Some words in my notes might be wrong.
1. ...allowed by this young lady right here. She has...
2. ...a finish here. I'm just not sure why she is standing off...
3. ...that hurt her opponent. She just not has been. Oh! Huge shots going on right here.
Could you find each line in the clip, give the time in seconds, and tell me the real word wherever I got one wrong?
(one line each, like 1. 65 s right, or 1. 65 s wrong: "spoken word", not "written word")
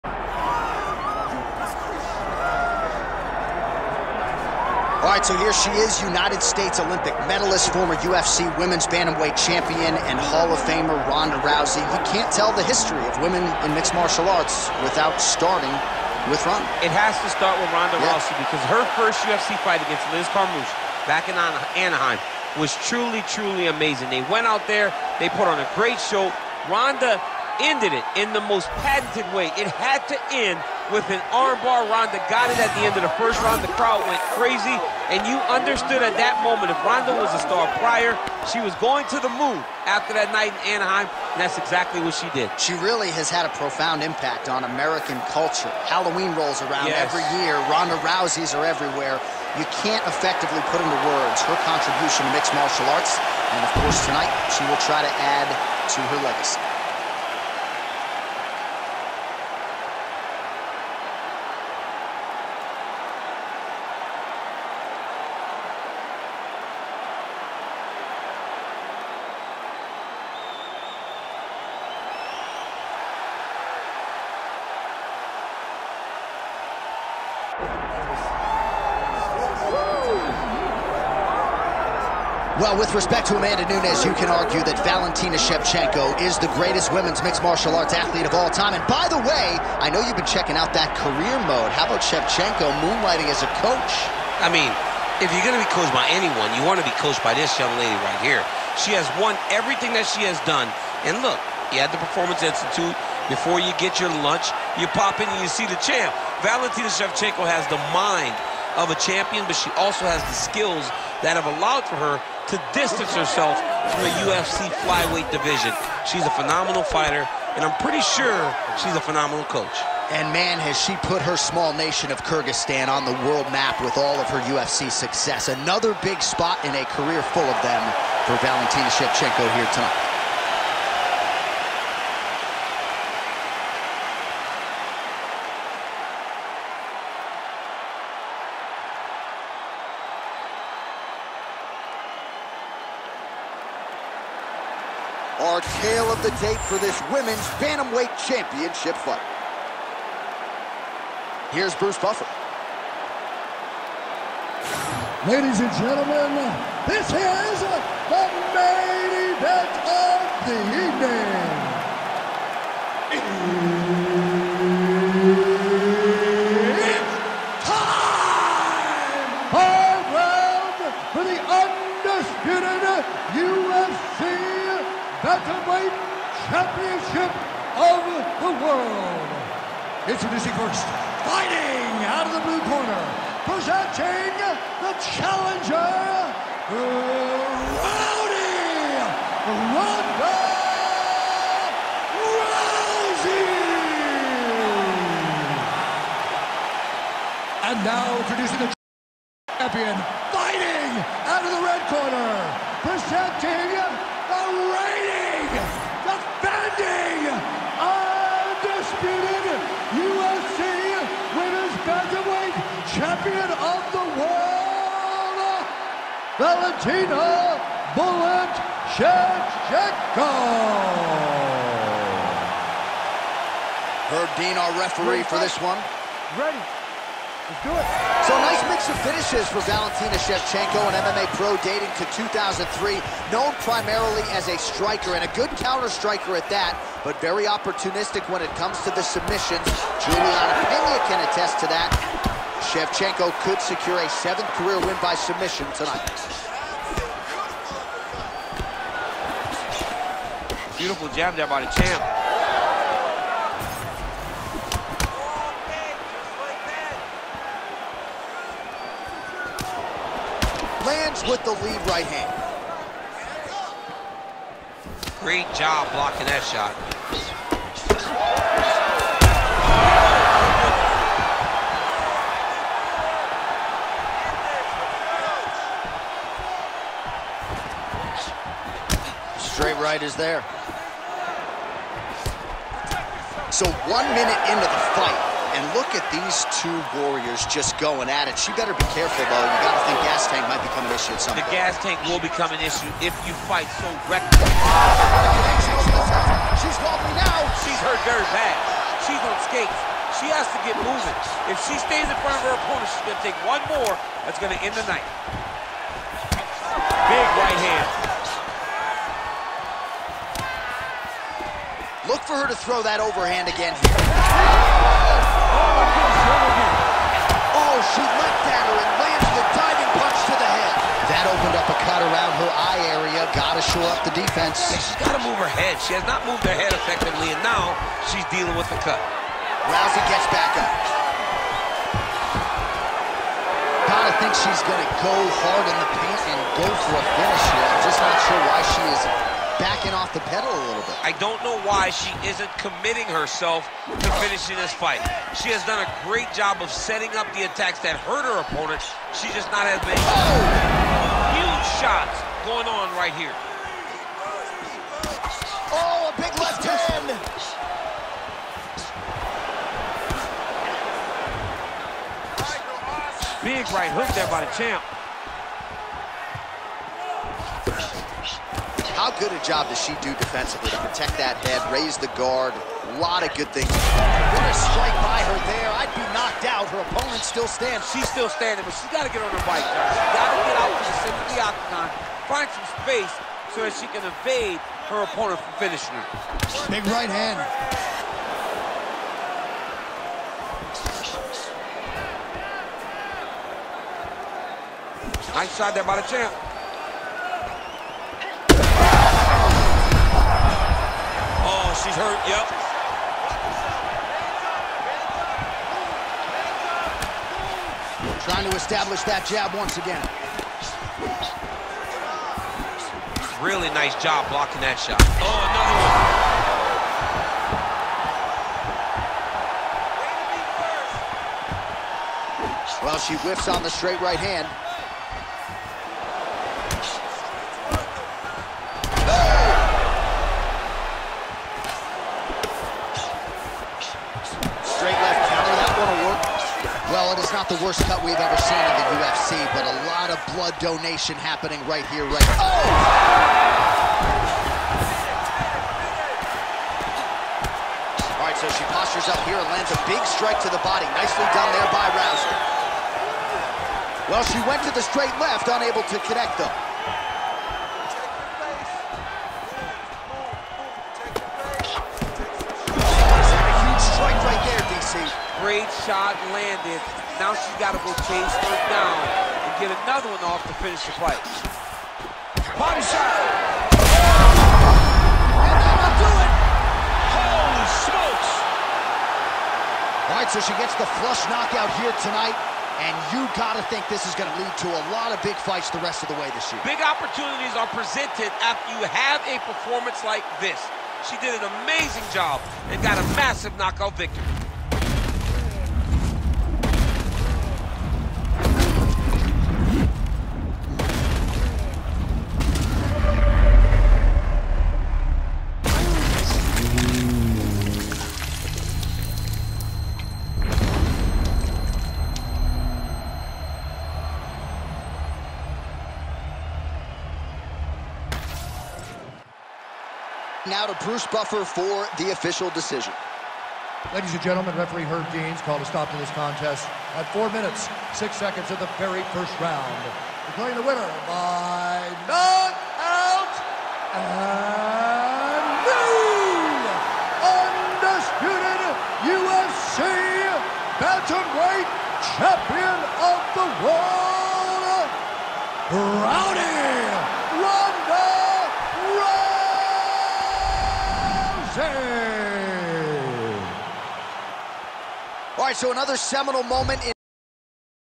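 1. 97 s wrong: "coached", not "allowed"
2. 336 s wrong: "backing", not "standing"
3. 347 s right.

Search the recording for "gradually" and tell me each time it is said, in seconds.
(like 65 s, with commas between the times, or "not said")
not said.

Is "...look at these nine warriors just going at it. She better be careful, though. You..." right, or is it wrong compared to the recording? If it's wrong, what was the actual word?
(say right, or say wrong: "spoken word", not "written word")
wrong: "two", not "nine".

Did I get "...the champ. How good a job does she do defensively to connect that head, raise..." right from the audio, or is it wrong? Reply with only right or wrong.
wrong.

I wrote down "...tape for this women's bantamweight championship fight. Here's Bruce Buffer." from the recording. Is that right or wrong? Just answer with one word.
right.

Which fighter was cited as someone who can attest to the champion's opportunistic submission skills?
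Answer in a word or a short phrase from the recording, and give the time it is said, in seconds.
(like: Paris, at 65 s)
Julianna Peña, at 240 s.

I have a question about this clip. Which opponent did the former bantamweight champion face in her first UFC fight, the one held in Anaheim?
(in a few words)
Liz Carmouche.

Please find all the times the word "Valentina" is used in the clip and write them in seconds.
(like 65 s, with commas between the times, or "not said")
84 s, 106 s, 128 s, 216 s, 229 s.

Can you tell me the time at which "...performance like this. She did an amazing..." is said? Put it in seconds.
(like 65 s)
489 s.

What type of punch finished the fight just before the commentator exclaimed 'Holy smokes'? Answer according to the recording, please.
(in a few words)
Body shot.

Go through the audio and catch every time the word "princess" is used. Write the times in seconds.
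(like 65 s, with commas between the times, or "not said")
not said.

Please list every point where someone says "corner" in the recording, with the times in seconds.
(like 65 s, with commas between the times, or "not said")
182 s, 201 s.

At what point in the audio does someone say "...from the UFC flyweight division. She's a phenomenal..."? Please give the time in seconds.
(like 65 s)
113 s.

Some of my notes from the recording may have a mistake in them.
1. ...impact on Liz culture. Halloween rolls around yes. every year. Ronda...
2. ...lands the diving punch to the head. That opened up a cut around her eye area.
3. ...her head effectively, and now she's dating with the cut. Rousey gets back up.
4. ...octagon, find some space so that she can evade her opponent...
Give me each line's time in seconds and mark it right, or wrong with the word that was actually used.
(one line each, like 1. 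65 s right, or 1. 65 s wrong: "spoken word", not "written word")
1. 44 s wrong: "American", not "Liz"
2. 318 s right
3. 326 s wrong: "dealing", not "dating"
4. 381 s right.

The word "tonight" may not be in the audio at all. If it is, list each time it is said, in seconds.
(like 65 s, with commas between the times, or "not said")
54 s, 129 s, 245 s, 482 s.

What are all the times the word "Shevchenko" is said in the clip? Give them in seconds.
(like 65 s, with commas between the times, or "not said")
85 s, 92 s, 106 s, 128 s, 218 s, 230 s, 242 s.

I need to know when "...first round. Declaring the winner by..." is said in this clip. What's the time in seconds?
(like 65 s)
529 s.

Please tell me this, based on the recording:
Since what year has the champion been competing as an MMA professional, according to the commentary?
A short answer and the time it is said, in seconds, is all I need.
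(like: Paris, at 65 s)
2003, at 232 s.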